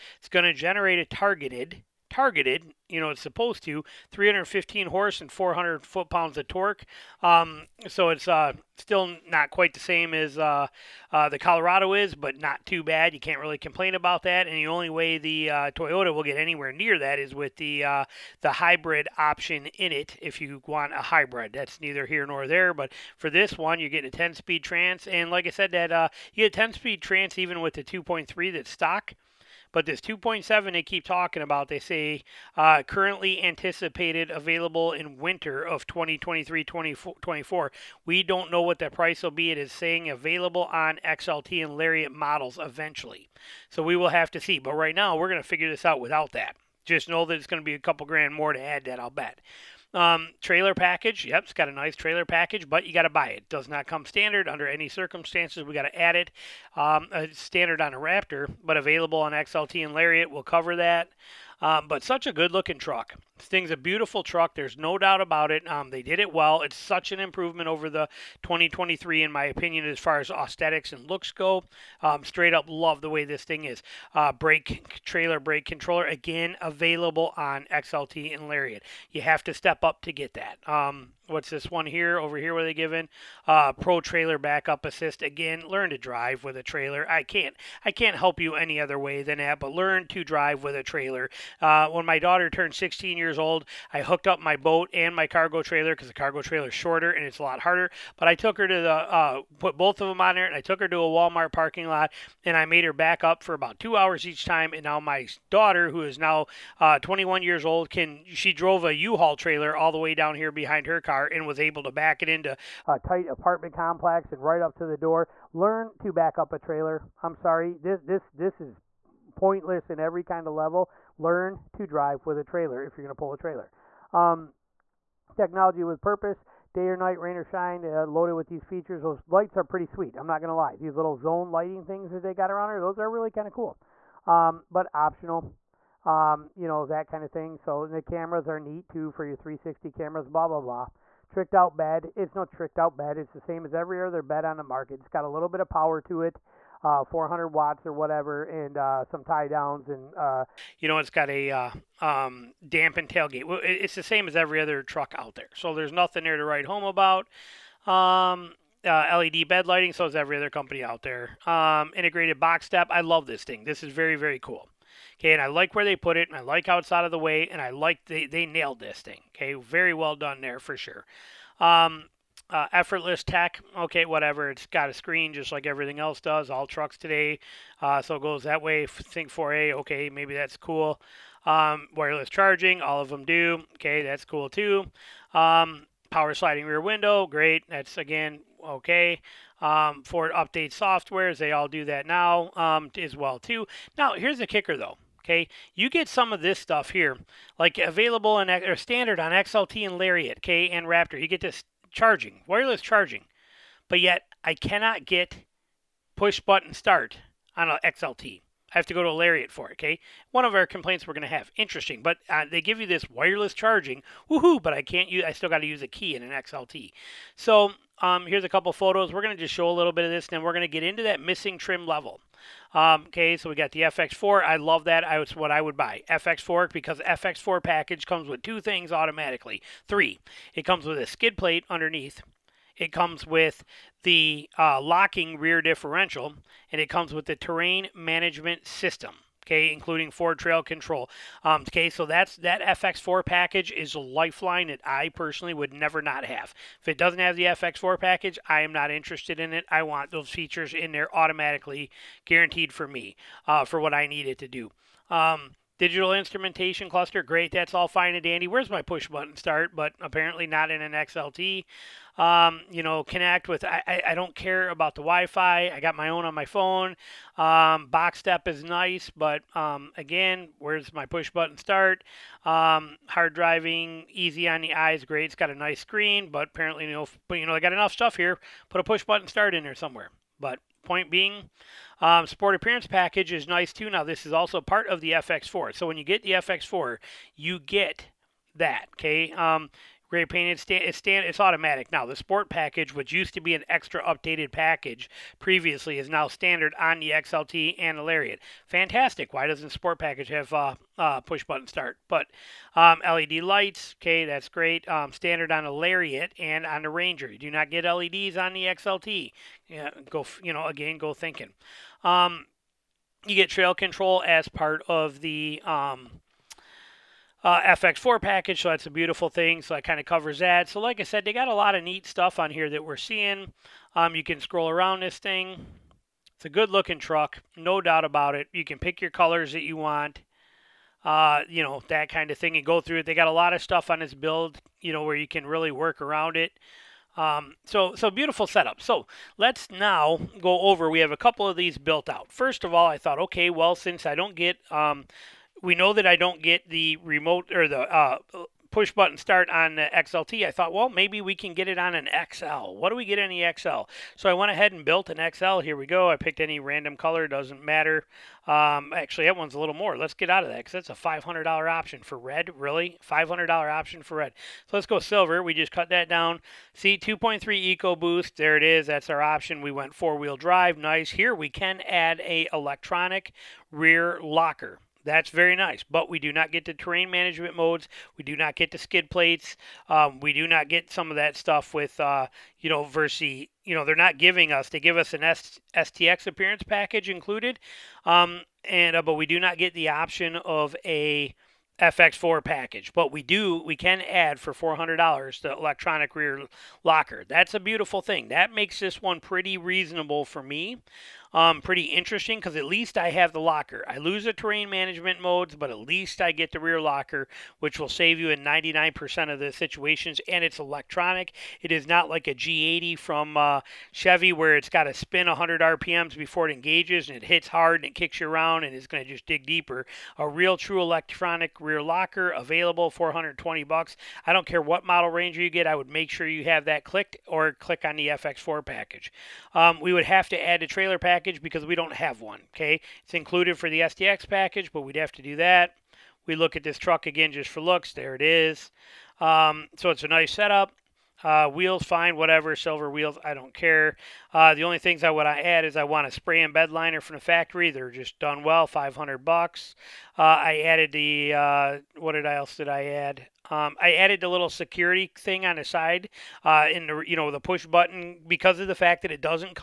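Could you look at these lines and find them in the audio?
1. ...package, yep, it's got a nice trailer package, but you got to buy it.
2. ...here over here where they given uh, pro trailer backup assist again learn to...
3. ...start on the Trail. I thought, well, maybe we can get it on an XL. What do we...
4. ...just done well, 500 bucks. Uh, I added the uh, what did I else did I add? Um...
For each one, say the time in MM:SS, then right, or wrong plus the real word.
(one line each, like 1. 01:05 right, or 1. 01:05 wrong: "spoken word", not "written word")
1. 00:50 right
2. 01:21 right
3. 05:49 wrong: "XLT", not "Trail"
4. 07:27 right.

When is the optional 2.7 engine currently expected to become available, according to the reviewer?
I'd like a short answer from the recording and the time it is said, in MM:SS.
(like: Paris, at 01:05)
Winter of 2023/2024, at 00:35.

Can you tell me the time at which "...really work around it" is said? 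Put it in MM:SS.
05:35.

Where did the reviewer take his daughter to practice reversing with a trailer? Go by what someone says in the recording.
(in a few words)
A Walmart parking lot.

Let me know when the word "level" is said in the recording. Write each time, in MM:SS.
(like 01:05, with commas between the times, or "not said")
02:00, 03:41.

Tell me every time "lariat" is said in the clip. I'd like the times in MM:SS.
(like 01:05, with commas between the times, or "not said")
00:41, 00:59, 01:18, 03:19, 03:29, 04:58, 05:05.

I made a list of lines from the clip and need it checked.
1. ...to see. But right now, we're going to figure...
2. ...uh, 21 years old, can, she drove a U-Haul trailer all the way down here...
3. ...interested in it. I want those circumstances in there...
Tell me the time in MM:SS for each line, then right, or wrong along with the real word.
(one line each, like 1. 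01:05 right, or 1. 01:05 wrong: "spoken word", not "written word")
1. 00:44 right
2. 01:46 right
3. 04:08 wrong: "features", not "circumstances".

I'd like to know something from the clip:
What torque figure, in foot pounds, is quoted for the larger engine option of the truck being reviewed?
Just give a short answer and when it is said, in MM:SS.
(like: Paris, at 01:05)
400, at 00:05.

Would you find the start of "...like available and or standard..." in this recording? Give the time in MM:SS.
03:17.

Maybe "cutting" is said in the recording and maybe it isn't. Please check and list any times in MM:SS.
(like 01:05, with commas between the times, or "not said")
not said.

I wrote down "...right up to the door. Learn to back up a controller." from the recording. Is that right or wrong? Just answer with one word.
wrong.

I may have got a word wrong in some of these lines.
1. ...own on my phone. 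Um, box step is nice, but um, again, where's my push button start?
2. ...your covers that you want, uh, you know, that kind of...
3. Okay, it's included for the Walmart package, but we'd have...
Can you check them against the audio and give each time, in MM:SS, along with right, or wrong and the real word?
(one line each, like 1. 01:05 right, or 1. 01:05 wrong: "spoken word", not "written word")
1. 04:26 right
2. 05:29 wrong: "colors", not "covers"
3. 07:12 wrong: "STX", not "Walmart".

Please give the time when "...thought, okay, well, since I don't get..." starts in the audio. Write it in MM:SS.
05:42.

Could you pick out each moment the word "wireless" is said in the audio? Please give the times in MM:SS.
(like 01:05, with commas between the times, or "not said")
03:01, 03:22, 03:33.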